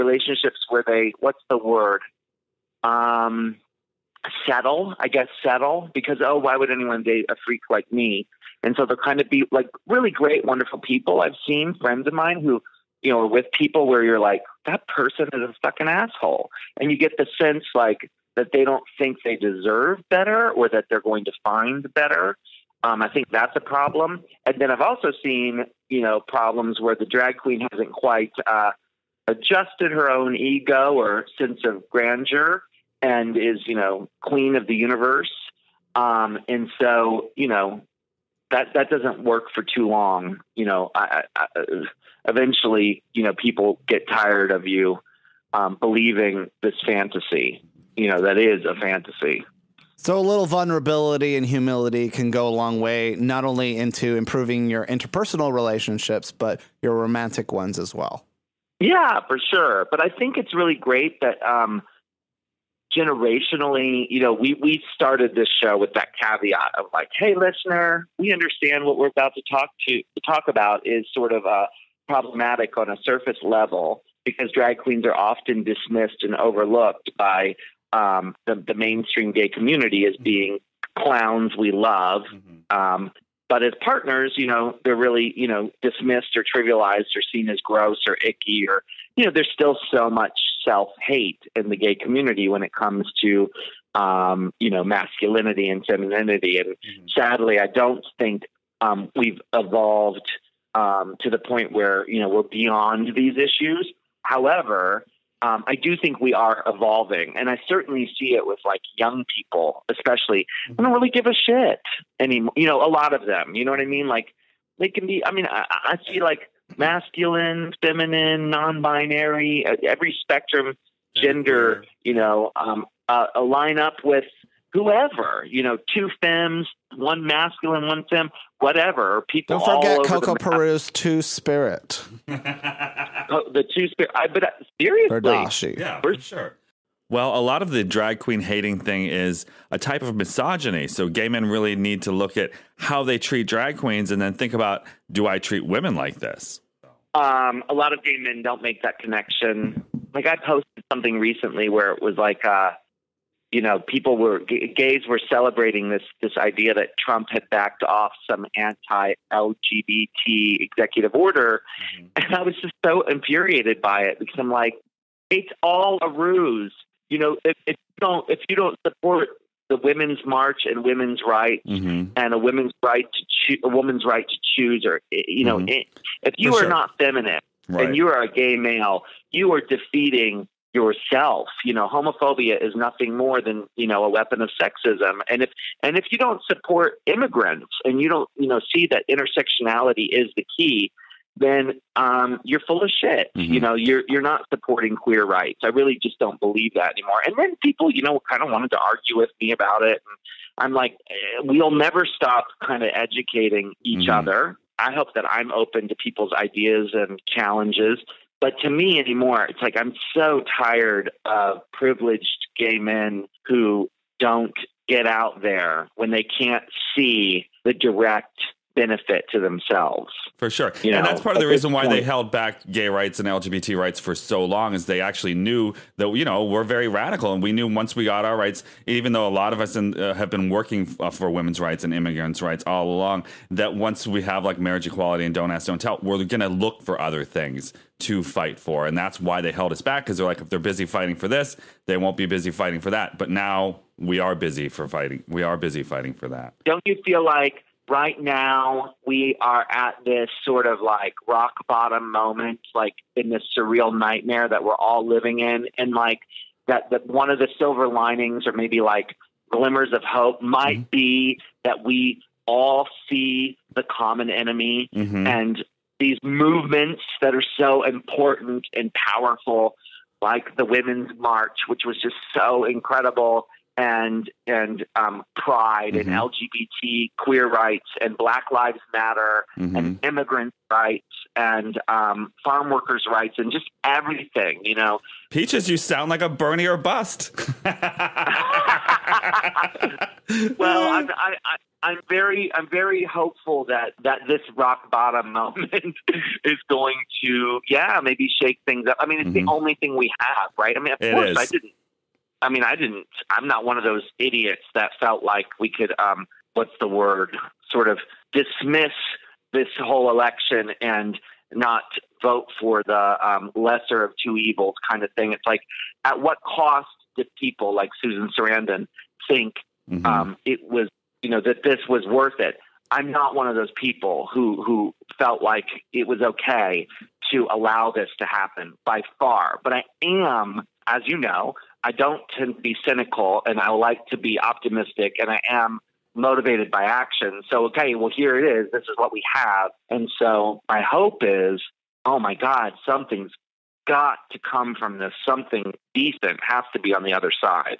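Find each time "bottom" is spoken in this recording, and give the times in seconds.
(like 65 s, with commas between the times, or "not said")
251 s, 294 s.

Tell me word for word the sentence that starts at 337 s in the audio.
So, okay, well, here it is.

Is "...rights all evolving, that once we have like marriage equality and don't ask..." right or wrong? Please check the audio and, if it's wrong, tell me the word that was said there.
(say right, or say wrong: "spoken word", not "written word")
wrong: "along", not "evolving".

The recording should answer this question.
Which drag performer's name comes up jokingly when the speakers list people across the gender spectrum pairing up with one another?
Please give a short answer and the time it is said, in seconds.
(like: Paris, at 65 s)
Coco Peru, at 130 s.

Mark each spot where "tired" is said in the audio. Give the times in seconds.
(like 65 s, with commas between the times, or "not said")
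44 s, 210 s.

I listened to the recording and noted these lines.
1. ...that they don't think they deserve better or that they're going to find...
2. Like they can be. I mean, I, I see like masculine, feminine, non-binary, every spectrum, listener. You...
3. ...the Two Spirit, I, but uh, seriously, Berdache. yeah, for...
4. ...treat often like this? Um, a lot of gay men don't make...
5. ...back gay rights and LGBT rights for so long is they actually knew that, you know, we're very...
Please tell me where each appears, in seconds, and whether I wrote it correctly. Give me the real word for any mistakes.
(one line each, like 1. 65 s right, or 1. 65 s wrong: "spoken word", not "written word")
1. 18 s right
2. 114 s wrong: "gender", not "listener"
3. 133 s right
4. 145 s wrong: "women", not "often"
5. 222 s right.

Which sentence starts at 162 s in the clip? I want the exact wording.
and I was just so infuriated by it because I'm like, it's all a ruse.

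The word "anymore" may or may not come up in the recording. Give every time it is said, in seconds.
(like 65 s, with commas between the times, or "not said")
112 s, 196 s, 208 s.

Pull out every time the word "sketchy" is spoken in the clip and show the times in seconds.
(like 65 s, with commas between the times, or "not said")
not said.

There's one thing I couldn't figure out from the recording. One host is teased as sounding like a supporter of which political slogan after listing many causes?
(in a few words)
Bernie or bust.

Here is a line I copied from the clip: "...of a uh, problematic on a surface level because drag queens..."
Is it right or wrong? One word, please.
right.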